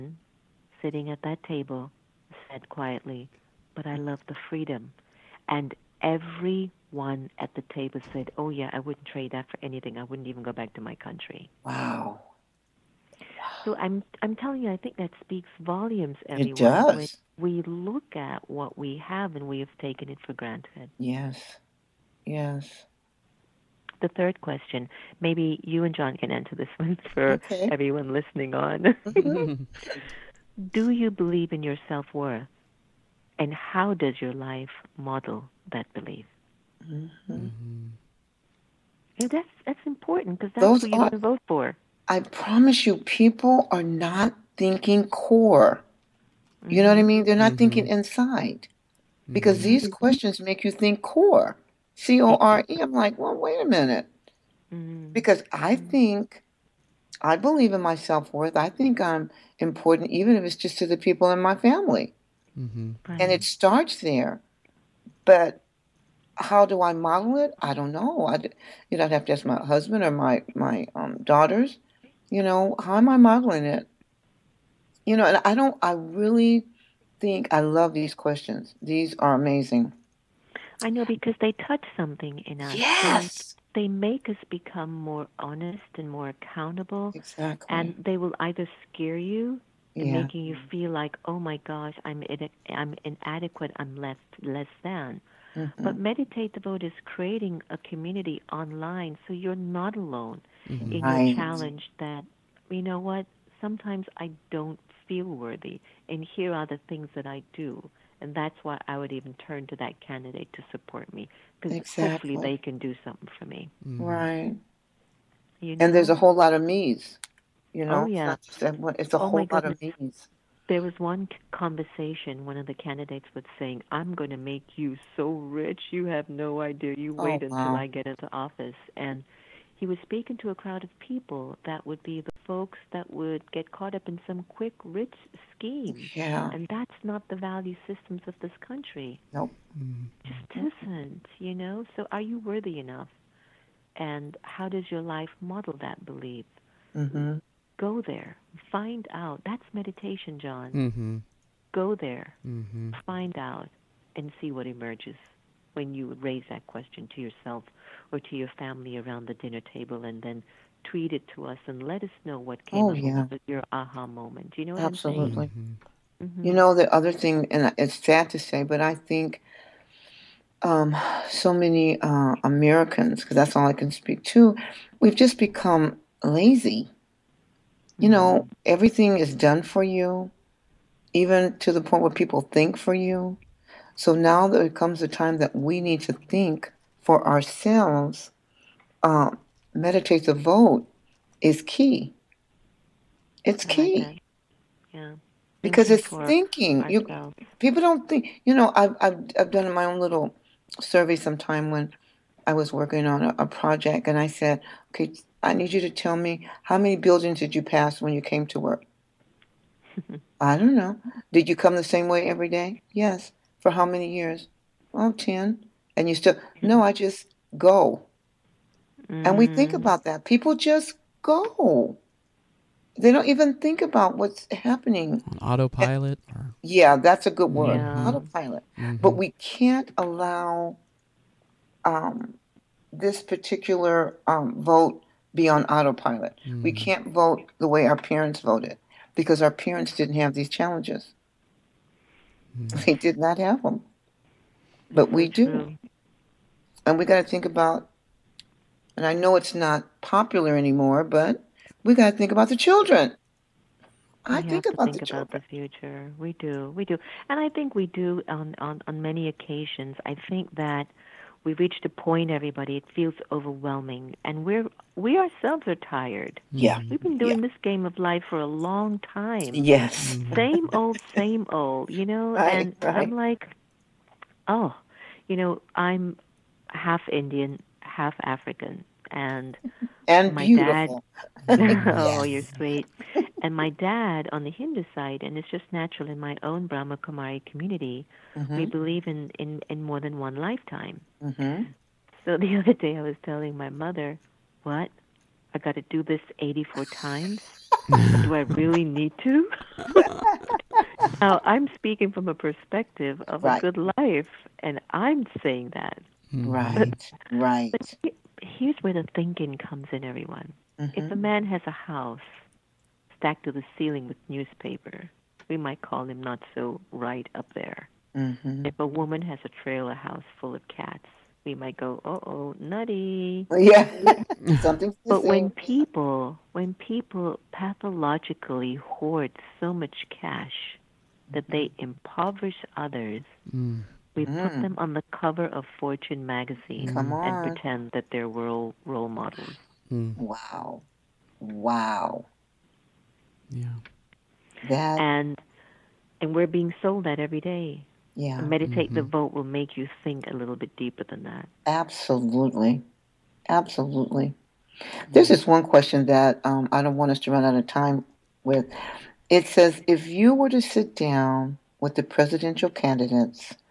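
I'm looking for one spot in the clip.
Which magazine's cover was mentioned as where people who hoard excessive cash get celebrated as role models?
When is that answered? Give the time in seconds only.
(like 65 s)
335 s.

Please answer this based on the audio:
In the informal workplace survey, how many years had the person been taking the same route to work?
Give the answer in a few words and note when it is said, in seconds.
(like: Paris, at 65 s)
10, at 215 s.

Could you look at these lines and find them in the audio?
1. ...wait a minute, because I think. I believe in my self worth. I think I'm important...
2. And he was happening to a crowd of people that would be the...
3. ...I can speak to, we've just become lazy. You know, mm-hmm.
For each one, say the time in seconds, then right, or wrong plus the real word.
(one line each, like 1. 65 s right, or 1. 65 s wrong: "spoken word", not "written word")
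1. 53 s right
2. 128 s wrong: "speaking", not "happening"
3. 173 s right.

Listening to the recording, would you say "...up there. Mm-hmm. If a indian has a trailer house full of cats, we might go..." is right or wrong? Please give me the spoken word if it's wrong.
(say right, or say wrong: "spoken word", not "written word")
wrong: "woman", not "indian".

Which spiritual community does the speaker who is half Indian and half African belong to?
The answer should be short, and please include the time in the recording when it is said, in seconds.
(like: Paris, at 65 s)
Brahma Kumari, at 286 s.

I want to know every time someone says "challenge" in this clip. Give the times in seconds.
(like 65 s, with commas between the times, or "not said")
101 s, 240 s.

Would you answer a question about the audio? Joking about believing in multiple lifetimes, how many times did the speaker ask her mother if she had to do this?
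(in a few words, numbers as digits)
84.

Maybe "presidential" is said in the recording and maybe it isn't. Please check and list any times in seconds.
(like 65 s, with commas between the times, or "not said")
362 s.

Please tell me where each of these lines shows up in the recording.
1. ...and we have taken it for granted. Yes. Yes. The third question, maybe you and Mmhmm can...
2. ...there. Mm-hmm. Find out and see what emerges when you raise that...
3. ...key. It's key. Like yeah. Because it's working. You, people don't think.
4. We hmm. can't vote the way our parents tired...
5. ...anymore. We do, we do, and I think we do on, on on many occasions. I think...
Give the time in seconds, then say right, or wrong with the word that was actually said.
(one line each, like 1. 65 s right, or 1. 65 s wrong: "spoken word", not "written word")
1. 19 s wrong: "John", not "Mmhmm"
2. 151 s right
3. 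191 s wrong: "thinking", not "working"
4. 236 s wrong: "voted", not "tired"
5. 255 s wrong: "future", not "anymore".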